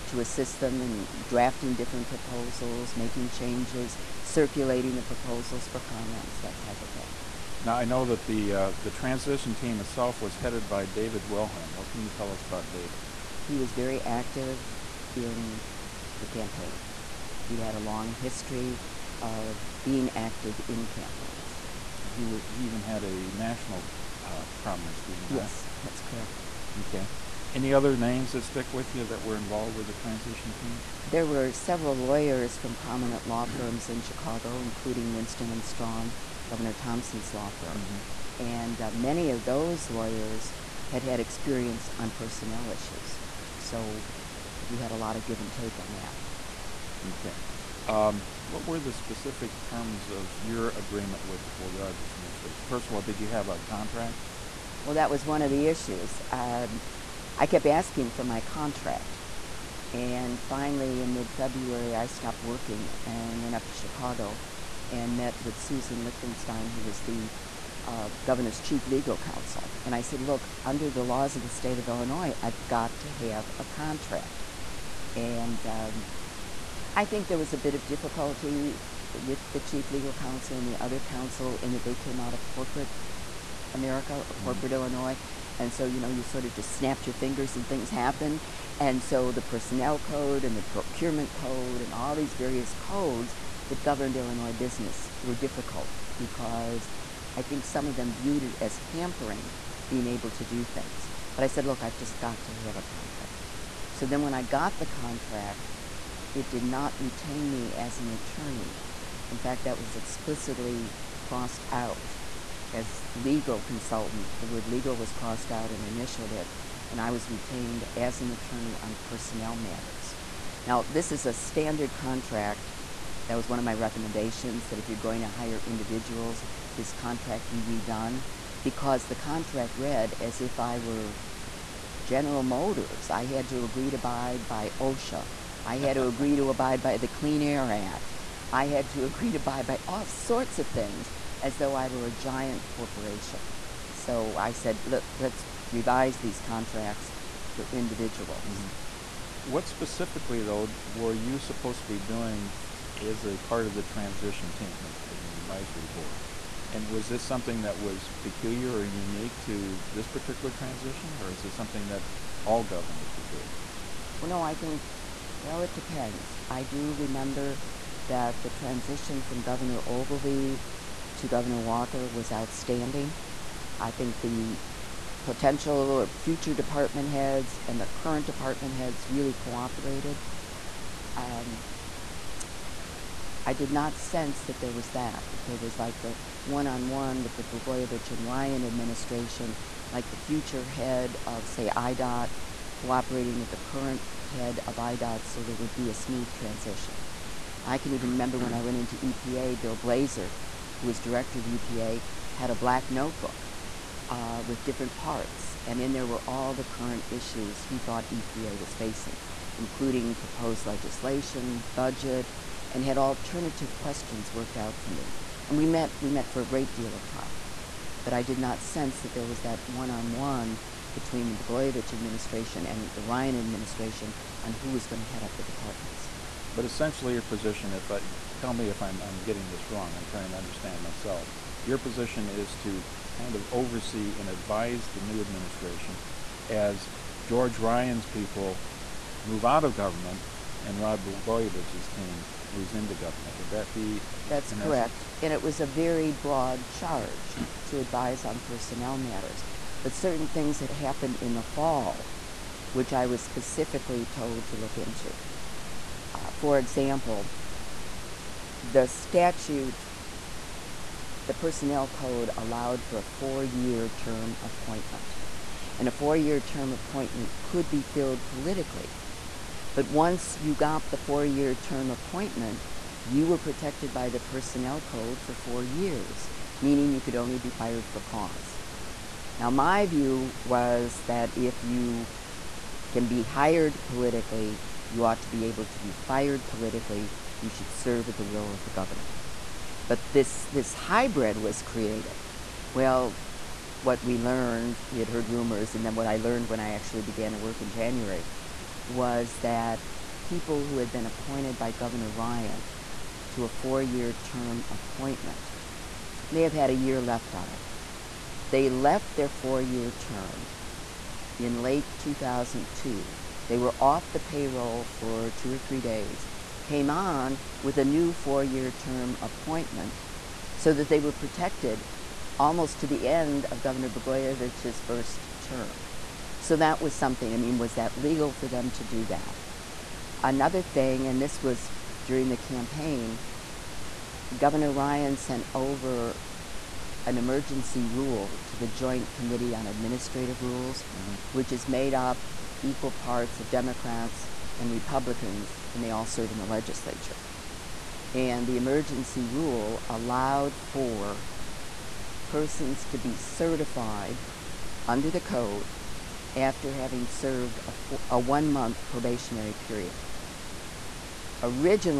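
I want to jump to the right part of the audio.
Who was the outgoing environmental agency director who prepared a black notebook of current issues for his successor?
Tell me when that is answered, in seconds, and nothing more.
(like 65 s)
199 s.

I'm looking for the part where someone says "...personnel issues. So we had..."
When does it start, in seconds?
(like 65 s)
42 s.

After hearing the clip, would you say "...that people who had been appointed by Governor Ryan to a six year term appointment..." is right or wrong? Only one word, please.
wrong.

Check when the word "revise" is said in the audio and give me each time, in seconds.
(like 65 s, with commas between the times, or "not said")
145 s.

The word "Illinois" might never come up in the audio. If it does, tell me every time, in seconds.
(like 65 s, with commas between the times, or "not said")
71 s, 84 s, 94 s.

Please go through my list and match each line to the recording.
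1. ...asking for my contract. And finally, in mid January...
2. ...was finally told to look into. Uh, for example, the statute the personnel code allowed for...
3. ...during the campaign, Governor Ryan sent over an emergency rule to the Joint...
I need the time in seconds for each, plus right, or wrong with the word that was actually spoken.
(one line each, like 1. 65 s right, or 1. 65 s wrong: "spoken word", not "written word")
1. 57 s wrong: "February", not "January"
2. 253 s wrong: "specifically", not "finally"
3. 332 s right.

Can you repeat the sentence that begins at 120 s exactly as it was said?
Now, this is a standard contract.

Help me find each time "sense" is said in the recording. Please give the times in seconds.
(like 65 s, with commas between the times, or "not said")
183 s, 218 s.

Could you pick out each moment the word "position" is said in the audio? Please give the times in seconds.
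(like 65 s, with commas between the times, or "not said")
227 s, 231 s.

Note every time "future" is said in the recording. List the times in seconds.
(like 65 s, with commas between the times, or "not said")
176 s, 190 s.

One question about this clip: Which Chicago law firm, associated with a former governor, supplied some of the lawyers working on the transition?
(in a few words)
Winston and Strawn.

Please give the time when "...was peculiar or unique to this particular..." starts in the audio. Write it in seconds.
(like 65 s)
157 s.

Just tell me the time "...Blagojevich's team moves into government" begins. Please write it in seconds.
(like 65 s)
241 s.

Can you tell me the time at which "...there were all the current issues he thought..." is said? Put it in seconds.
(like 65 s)
205 s.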